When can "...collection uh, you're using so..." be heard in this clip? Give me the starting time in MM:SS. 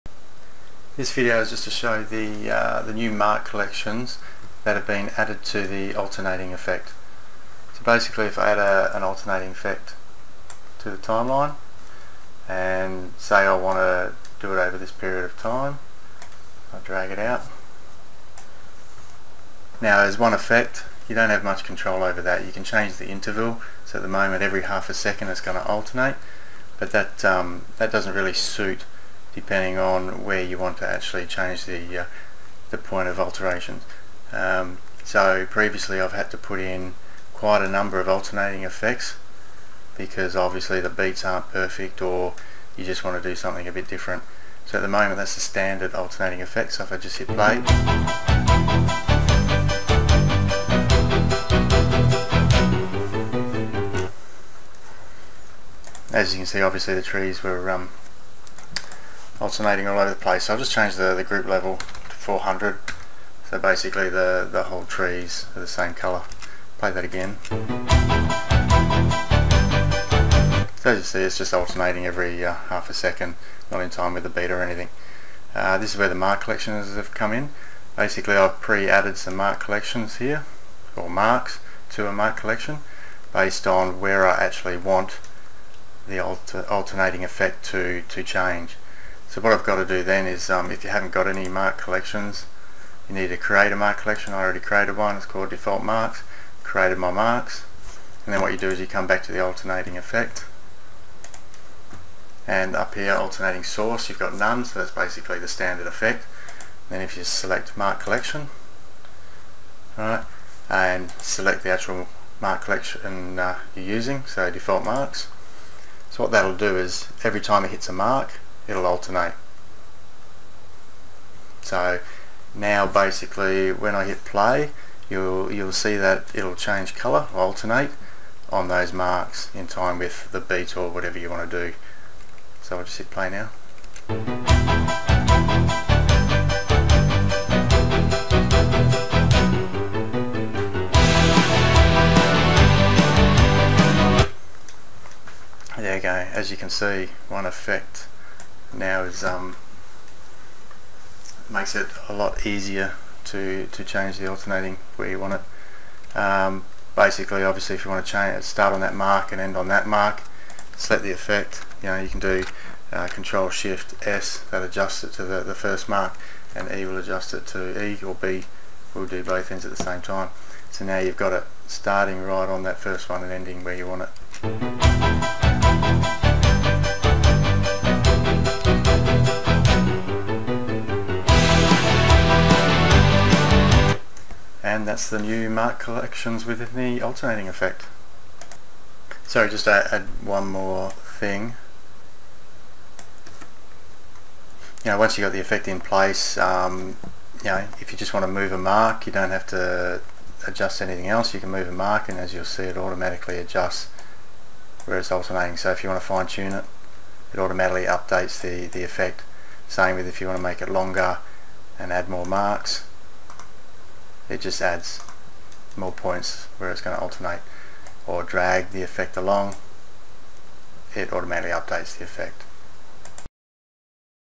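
01:52.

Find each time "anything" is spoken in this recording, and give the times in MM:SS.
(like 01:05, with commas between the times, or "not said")
01:14, 03:20.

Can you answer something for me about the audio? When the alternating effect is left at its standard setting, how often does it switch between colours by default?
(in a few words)
every half a second.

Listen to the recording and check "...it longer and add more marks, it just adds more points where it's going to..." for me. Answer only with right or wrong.
right.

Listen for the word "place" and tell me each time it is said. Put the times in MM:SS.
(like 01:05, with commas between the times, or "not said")
01:00, 03:15.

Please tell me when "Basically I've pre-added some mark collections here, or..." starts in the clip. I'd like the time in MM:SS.
01:17.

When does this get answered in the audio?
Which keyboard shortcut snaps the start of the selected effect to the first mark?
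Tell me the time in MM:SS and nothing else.
02:43.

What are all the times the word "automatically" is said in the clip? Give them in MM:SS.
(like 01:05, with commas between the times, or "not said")
03:22, 03:27, 03:41.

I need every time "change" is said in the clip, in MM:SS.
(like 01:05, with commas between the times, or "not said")
00:22, 00:31, 01:00, 01:28, 02:06, 02:33, 02:38.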